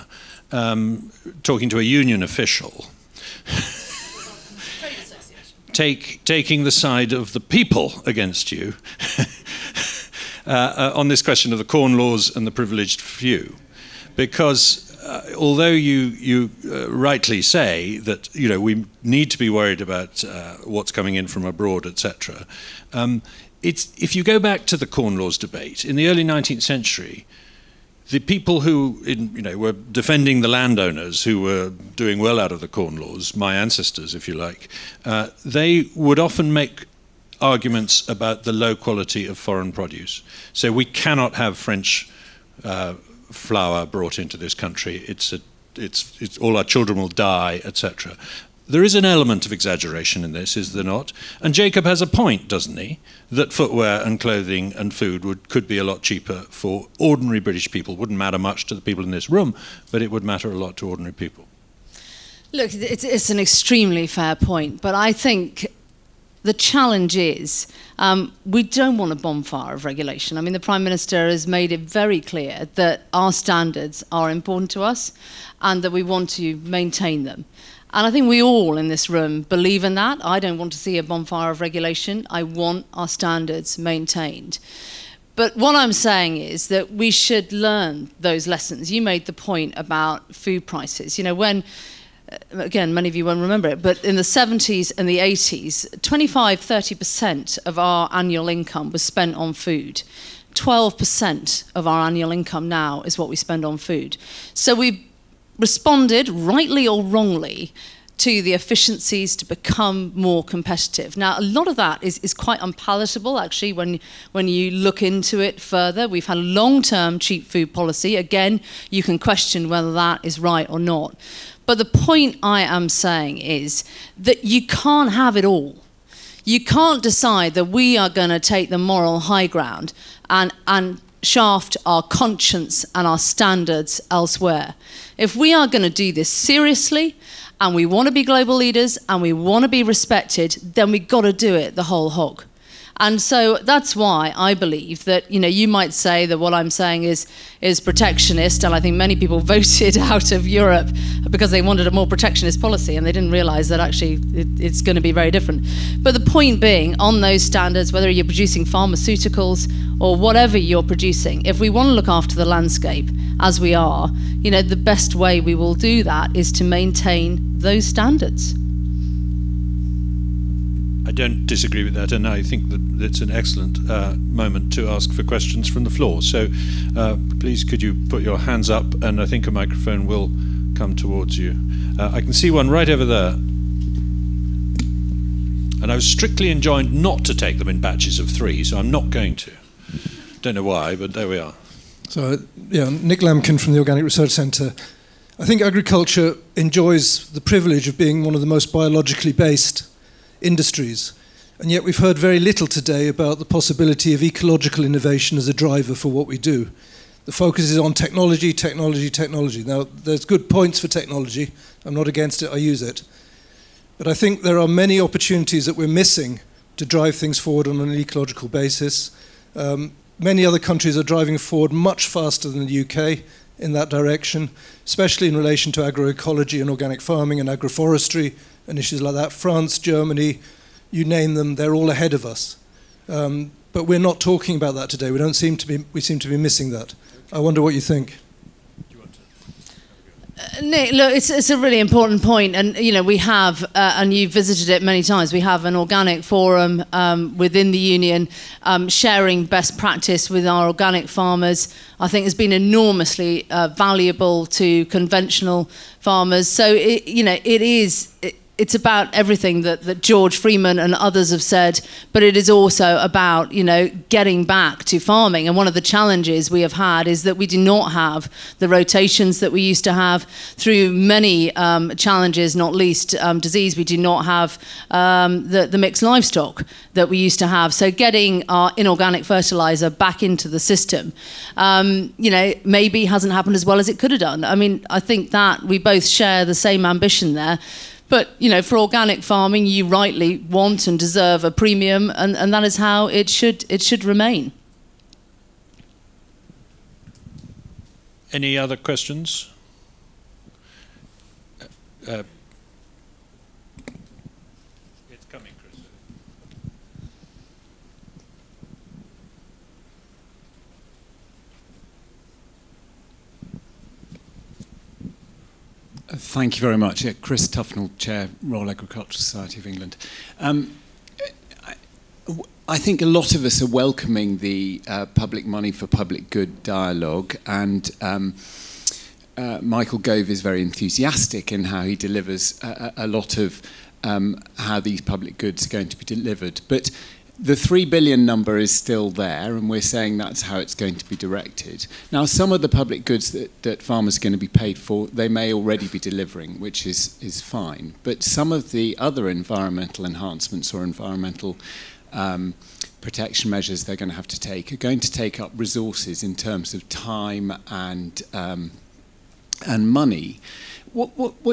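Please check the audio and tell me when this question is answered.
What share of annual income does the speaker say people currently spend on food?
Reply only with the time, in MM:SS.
01:40.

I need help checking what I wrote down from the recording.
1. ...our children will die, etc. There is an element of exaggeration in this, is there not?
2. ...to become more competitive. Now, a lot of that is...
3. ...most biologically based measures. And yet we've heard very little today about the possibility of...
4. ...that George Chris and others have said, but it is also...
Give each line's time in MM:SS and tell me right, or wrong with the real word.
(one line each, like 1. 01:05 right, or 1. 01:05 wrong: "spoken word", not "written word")
1. 00:46 right
2. 01:49 right
3. 03:18 wrong: "industries", not "measures"
4. 04:19 wrong: "Freeman", not "Chris".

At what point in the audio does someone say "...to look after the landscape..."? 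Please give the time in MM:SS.
02:41.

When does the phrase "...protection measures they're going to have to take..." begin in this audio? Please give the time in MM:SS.
05:52.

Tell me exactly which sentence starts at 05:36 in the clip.
But the 3 billion number is still there, and we're saying that's how it's going to be directed.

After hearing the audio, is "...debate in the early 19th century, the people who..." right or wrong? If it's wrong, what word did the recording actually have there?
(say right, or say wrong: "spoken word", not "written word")
right.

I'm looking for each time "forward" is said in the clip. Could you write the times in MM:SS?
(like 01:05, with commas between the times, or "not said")
03:37, 03:41.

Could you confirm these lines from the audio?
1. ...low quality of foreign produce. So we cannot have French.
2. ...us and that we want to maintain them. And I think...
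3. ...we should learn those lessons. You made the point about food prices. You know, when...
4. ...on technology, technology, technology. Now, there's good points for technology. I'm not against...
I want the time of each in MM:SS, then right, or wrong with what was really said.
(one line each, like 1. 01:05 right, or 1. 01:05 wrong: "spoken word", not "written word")
1. 00:38 right
2. 01:14 right
3. 01:26 right
4. 03:27 right.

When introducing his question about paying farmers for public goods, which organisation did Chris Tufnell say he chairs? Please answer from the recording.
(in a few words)
Royal Agricultural Society of England.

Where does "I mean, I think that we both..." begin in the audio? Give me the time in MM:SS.
04:44.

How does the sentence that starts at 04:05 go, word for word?
We have an organic forum um, within the union, um, sharing best practice with our organic farmers.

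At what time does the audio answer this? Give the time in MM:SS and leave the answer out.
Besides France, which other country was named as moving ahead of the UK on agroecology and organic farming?
03:49.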